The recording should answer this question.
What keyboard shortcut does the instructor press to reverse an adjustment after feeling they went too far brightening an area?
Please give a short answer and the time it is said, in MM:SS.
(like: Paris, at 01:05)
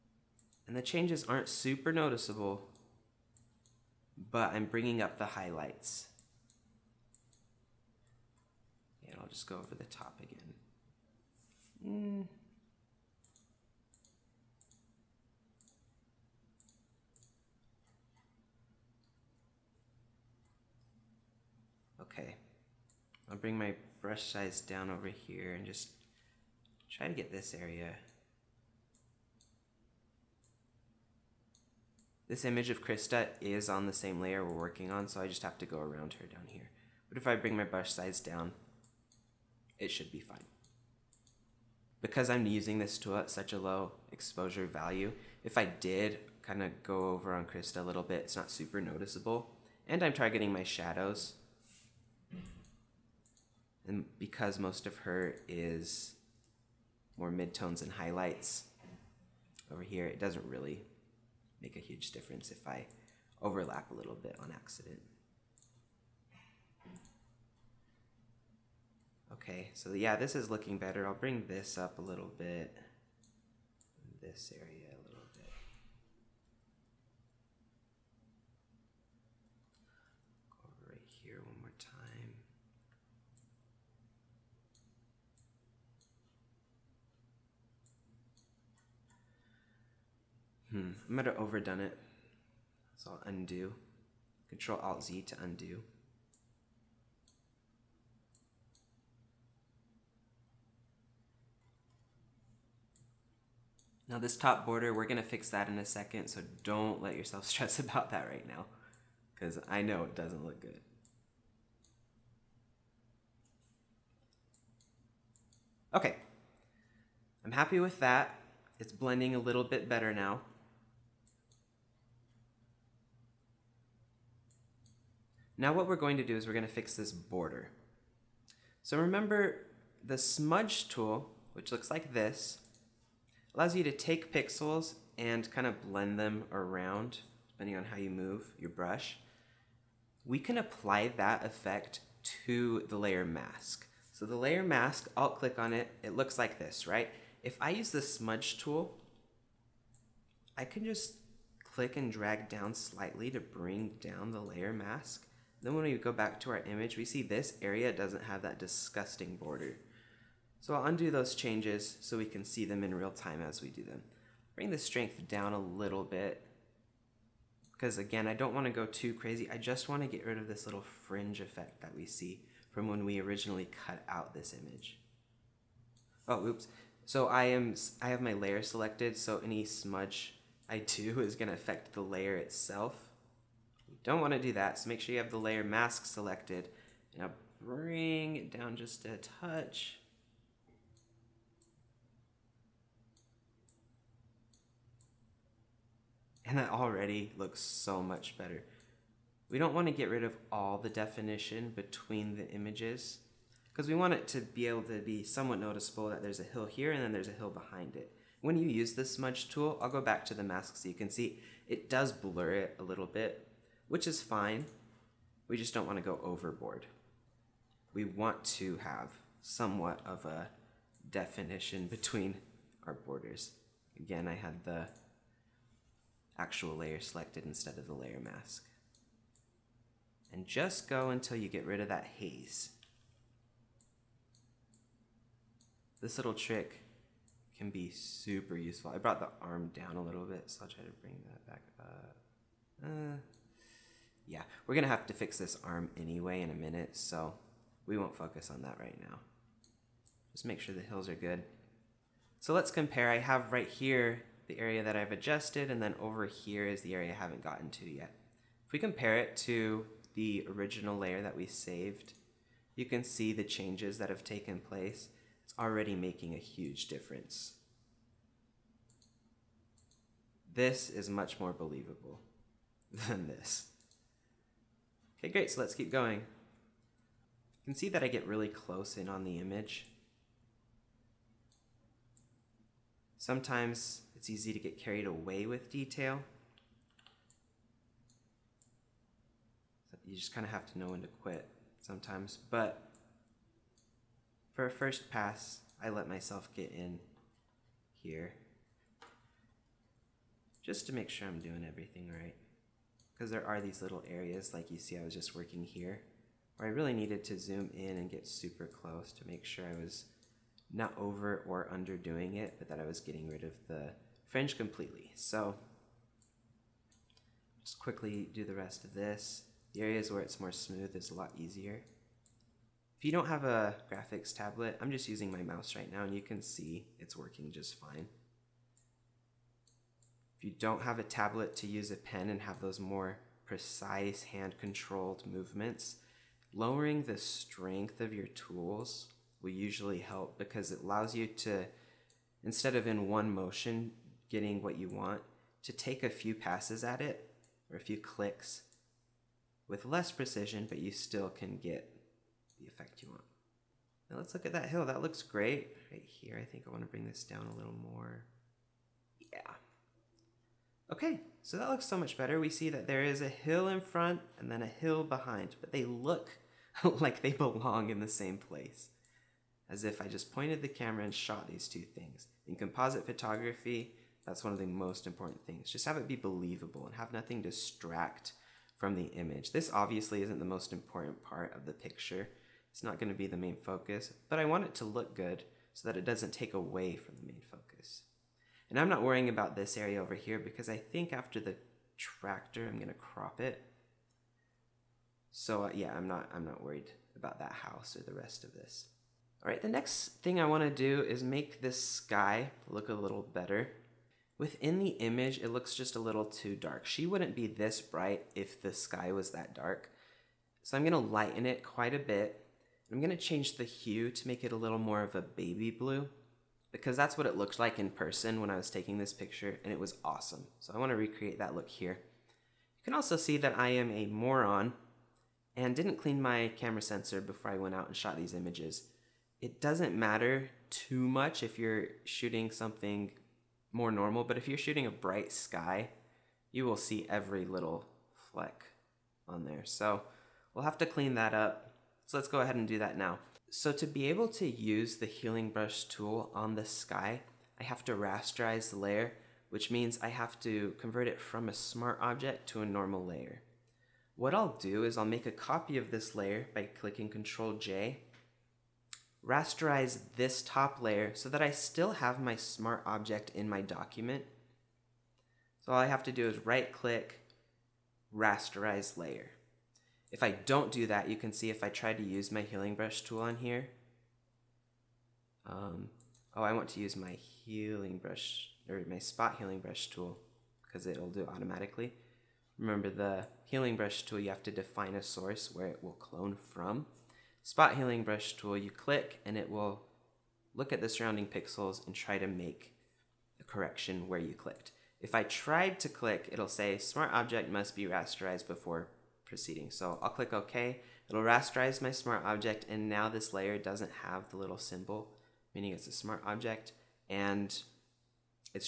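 Control Alt Z, at 01:34.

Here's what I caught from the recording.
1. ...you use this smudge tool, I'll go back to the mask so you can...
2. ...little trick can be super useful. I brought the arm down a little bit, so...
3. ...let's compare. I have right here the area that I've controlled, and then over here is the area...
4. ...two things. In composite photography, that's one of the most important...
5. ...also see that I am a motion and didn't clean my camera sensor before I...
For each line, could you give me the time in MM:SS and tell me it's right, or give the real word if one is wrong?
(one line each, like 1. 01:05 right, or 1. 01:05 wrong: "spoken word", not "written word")
1. 03:28 right
2. 03:56 right
3. 04:12 wrong: "adjusted", not "controlled"
4. 06:11 right
5. 07:02 wrong: "moron", not "motion".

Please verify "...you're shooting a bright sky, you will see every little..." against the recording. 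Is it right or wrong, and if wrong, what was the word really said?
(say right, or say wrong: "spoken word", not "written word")
right.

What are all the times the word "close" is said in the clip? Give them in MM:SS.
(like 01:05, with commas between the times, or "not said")
04:38, 05:08.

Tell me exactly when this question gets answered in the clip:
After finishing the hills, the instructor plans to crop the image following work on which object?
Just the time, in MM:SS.
06:31.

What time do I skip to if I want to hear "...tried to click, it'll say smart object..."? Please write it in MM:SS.
08:15.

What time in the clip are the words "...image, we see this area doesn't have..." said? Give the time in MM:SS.
02:36.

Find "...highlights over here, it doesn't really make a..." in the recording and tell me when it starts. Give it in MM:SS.
00:57.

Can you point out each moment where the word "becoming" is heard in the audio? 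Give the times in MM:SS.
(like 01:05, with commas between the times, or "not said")
not said.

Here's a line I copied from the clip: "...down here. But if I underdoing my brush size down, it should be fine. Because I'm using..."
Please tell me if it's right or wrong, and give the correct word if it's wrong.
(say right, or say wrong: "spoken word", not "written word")
wrong: "bring", not "underdoing".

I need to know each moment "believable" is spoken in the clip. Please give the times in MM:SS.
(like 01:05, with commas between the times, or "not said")
04:31, 06:16.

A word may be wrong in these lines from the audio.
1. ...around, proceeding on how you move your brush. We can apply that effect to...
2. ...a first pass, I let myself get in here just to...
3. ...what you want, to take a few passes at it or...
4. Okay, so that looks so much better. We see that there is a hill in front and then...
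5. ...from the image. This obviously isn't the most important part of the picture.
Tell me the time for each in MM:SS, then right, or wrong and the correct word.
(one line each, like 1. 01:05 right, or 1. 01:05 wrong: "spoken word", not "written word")
1. 02:16 wrong: "depending", not "proceeding"
2. 04:54 right
3. 05:44 right
4. 06:00 right
5. 06:18 right.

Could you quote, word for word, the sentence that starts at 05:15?
So just quickly do the rest of this.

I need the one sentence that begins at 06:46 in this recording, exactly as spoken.
She wouldn't be this bright if the sky was that dark.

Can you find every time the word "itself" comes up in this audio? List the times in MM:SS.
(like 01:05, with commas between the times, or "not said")
03:02.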